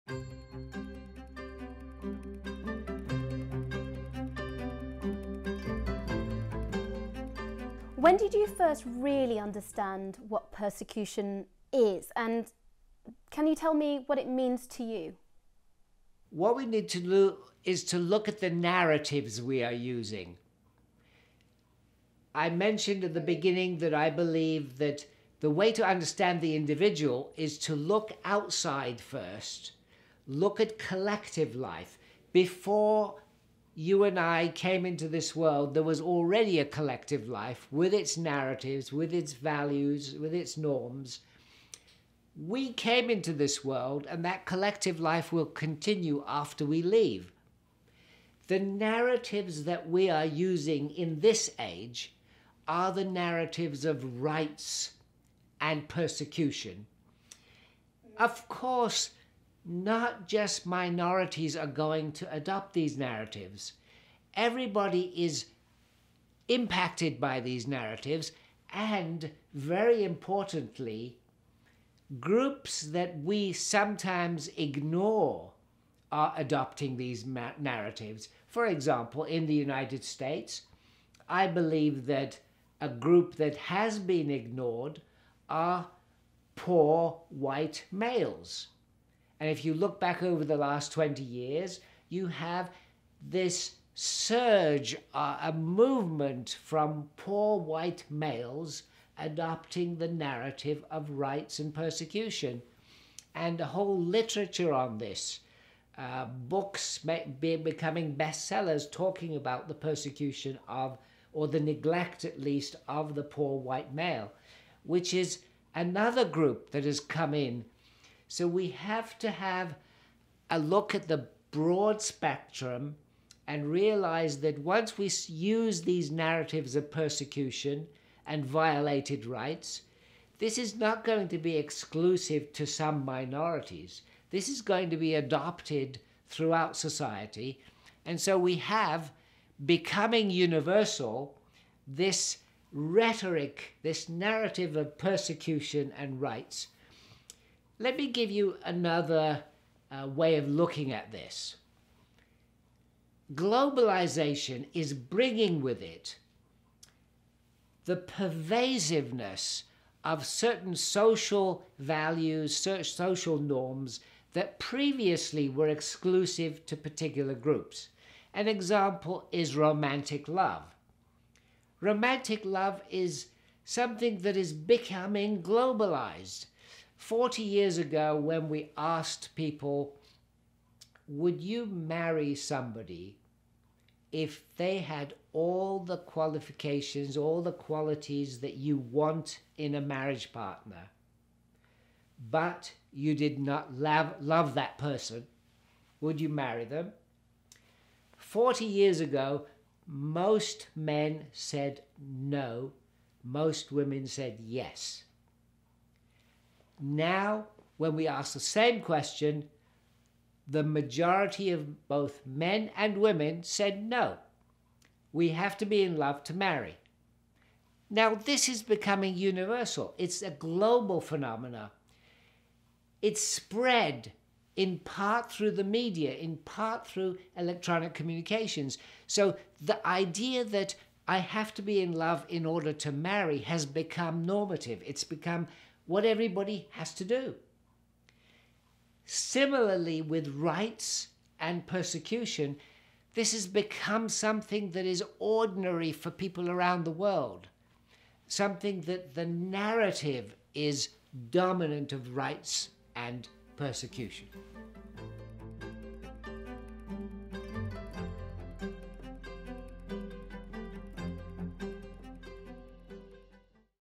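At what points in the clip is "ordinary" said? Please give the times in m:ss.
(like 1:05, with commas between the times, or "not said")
4:05.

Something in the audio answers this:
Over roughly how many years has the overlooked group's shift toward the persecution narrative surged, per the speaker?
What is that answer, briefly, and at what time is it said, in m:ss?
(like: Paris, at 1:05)
20 years, at 1:30.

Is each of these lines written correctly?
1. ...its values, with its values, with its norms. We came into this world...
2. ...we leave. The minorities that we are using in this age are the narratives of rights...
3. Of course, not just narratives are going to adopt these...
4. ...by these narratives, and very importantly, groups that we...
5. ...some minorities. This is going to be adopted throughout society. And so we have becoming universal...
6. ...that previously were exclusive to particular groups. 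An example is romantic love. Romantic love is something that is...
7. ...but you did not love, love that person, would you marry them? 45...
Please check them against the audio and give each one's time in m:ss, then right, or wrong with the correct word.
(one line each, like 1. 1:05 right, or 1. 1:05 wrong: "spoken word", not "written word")
1. 0:37 wrong: "narratives", not "values"
2. 0:46 wrong: "narratives", not "minorities"
3. 0:58 wrong: "minorities", not "narratives"
4. 1:07 right
5. 2:12 right
6. 2:44 right
7. 3:12 wrong: "40", not "45".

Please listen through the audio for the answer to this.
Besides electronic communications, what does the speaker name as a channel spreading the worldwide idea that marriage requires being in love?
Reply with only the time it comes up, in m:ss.
3:45.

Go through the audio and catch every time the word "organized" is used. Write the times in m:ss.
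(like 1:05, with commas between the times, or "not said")
not said.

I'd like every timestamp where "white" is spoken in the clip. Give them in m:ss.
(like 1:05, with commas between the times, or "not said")
1:27, 1:37, 1:53.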